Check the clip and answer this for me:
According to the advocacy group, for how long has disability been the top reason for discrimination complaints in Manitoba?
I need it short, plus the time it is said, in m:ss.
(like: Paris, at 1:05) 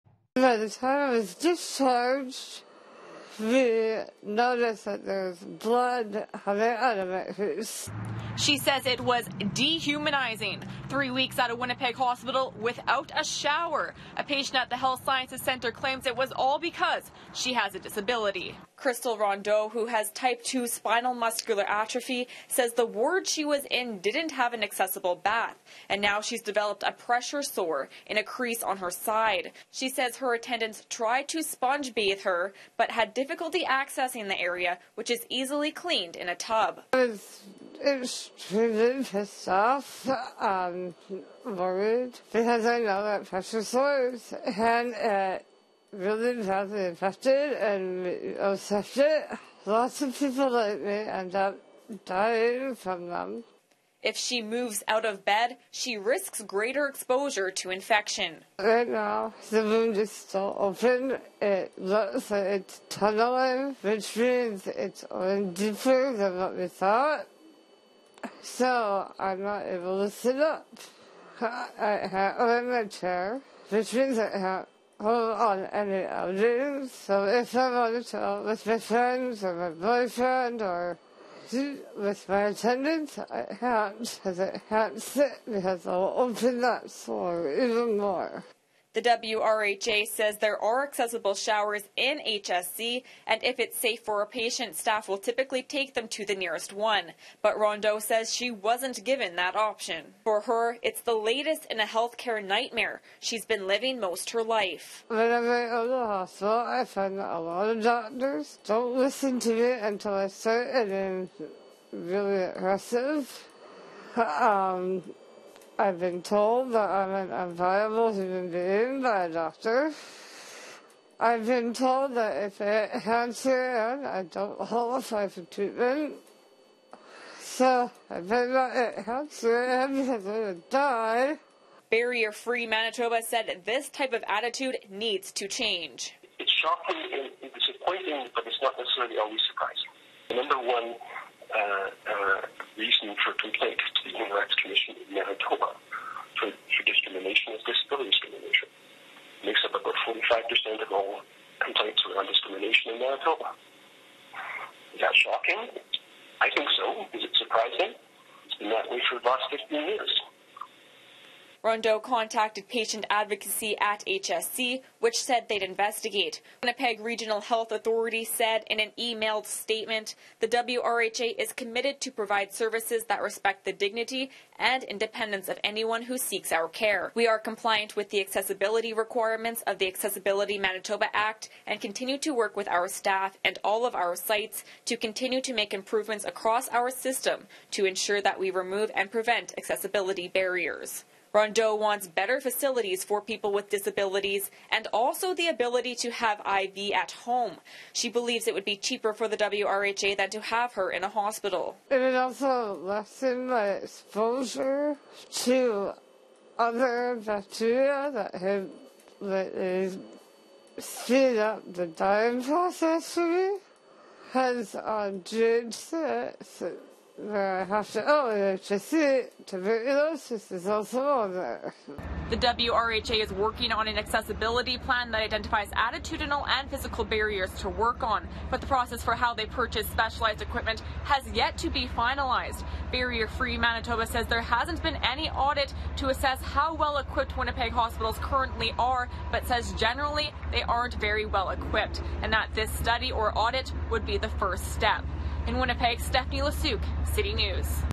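15 years, at 2:39.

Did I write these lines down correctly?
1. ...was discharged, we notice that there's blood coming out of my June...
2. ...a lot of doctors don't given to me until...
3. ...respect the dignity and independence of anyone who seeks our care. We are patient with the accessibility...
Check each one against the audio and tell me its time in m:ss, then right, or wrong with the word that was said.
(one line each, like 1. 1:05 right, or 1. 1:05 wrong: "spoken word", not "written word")
1. 0:01 wrong: "She", not "June"
2. 1:47 wrong: "listen", not "given"
3. 2:53 wrong: "compliant", not "patient".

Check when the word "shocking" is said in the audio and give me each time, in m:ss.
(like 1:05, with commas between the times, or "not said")
2:16, 2:35.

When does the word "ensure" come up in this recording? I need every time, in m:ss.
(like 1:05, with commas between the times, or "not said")
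3:07.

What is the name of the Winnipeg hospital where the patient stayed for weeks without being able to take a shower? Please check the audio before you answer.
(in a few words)
Health Sciences Center.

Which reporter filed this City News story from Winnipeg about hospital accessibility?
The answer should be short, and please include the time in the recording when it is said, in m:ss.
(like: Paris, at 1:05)
Stephanie Lasuk, at 4:05.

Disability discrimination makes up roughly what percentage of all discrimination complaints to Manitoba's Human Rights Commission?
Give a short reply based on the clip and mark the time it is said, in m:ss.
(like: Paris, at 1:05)
45%, at 2:30.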